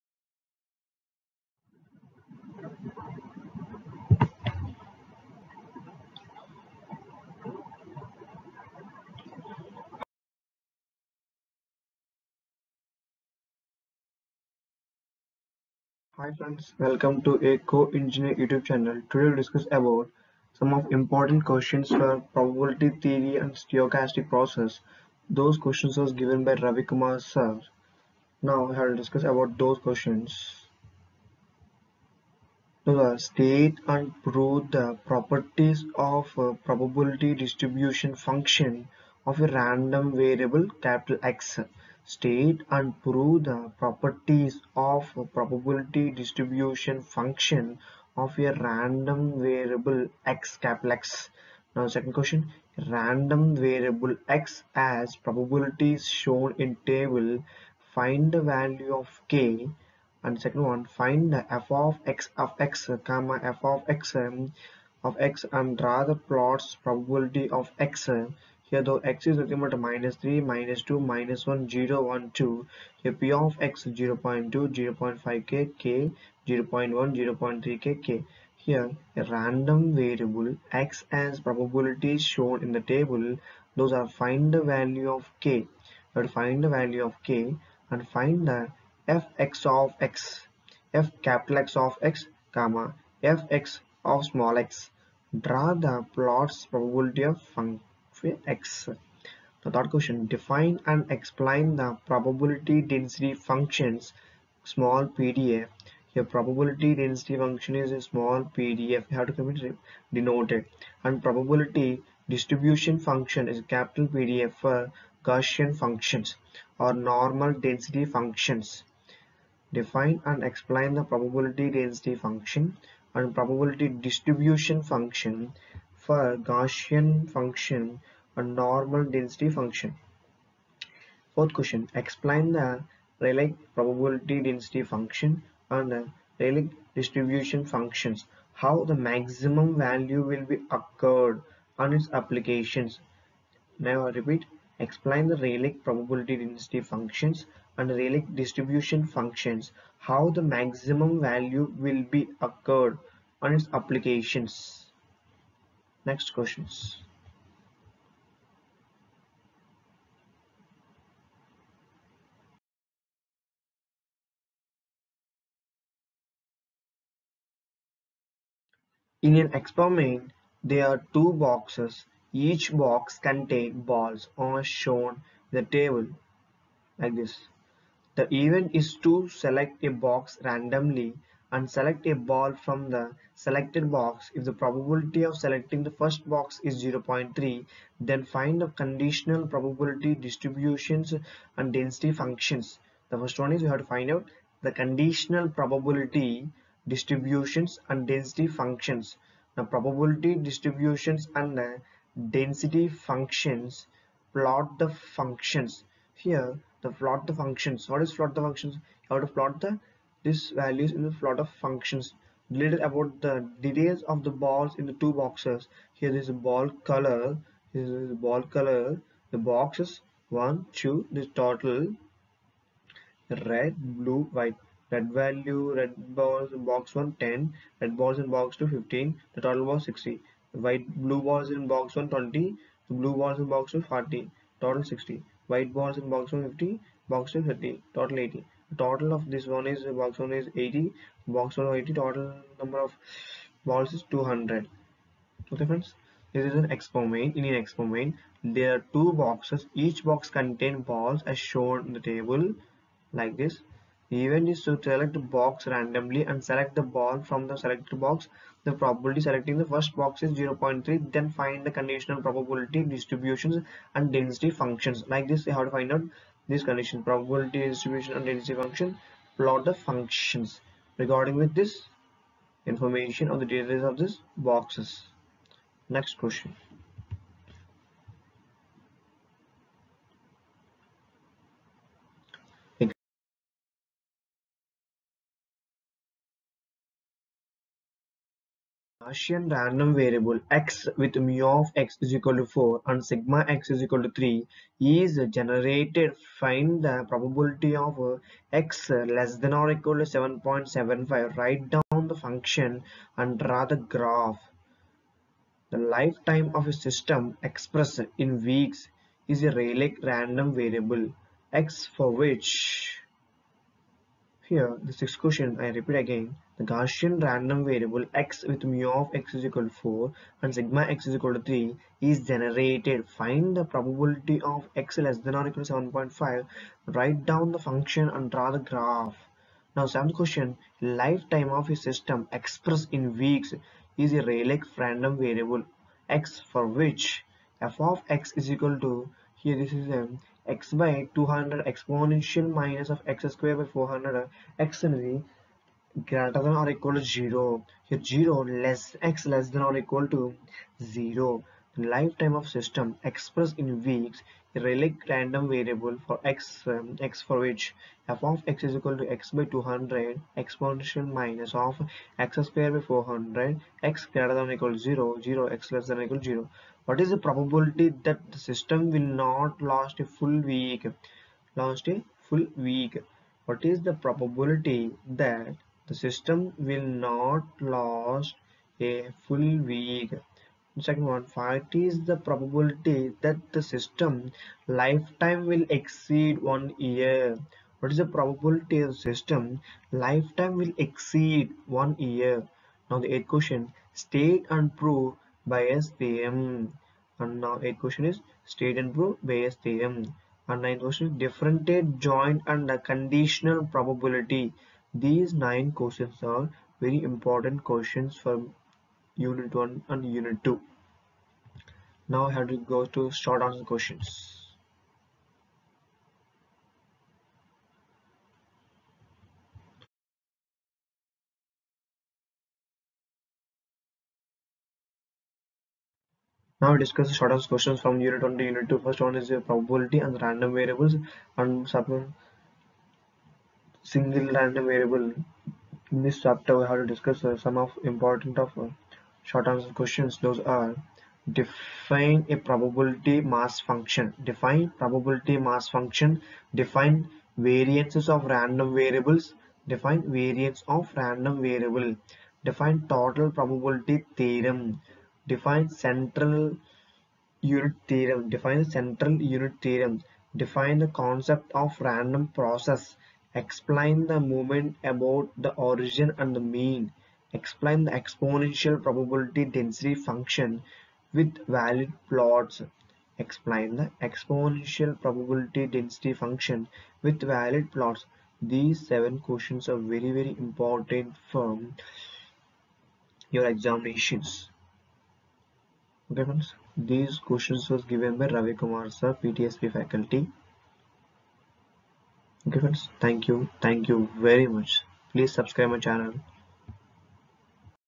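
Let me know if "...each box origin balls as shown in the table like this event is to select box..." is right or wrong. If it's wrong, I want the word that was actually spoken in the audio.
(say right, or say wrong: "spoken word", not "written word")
wrong: "contain", not "origin".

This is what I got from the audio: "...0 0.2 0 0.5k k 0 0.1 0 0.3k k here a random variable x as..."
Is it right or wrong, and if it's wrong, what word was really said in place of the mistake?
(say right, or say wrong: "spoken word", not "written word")
right.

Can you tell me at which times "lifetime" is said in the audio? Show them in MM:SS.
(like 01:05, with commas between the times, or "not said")
05:05, 05:30, 05:51, 06:24, 06:29.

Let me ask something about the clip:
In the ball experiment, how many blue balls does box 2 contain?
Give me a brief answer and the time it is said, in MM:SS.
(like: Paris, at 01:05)
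40, at 03:53.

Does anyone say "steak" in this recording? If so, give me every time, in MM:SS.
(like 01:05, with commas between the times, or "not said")
not said.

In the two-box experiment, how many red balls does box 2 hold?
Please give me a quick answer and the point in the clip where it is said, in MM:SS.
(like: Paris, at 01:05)
15, at 03:48.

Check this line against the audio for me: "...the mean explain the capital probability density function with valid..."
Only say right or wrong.
wrong.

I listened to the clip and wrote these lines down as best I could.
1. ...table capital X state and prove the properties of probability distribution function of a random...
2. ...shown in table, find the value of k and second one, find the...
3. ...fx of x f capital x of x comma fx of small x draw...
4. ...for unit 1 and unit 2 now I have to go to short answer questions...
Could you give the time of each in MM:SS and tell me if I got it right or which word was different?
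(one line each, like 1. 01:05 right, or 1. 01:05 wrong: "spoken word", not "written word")
1. 00:40 wrong: "variable", not "table"
2. 00:56 right
3. 01:29 right
4. 06:48 right.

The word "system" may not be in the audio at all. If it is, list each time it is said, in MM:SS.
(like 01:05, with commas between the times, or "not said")
05:06, 05:31, 05:52, 06:08, 06:15, 06:23, 06:29.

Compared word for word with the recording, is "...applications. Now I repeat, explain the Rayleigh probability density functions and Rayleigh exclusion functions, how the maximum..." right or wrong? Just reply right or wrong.
wrong.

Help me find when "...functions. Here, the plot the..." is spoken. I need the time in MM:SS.
03:24.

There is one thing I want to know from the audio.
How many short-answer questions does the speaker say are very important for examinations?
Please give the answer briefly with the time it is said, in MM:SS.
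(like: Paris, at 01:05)
7, at 07:58.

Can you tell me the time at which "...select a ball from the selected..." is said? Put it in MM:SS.
03:01.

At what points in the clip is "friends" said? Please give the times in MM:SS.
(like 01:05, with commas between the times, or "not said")
00:16, 04:05, 08:06, 08:12.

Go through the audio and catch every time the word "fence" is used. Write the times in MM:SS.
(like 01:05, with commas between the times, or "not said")
not said.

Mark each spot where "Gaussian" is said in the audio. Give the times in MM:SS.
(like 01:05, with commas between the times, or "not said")
01:55, 02:06, 04:49, 05:16.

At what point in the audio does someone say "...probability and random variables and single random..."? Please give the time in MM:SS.
07:09.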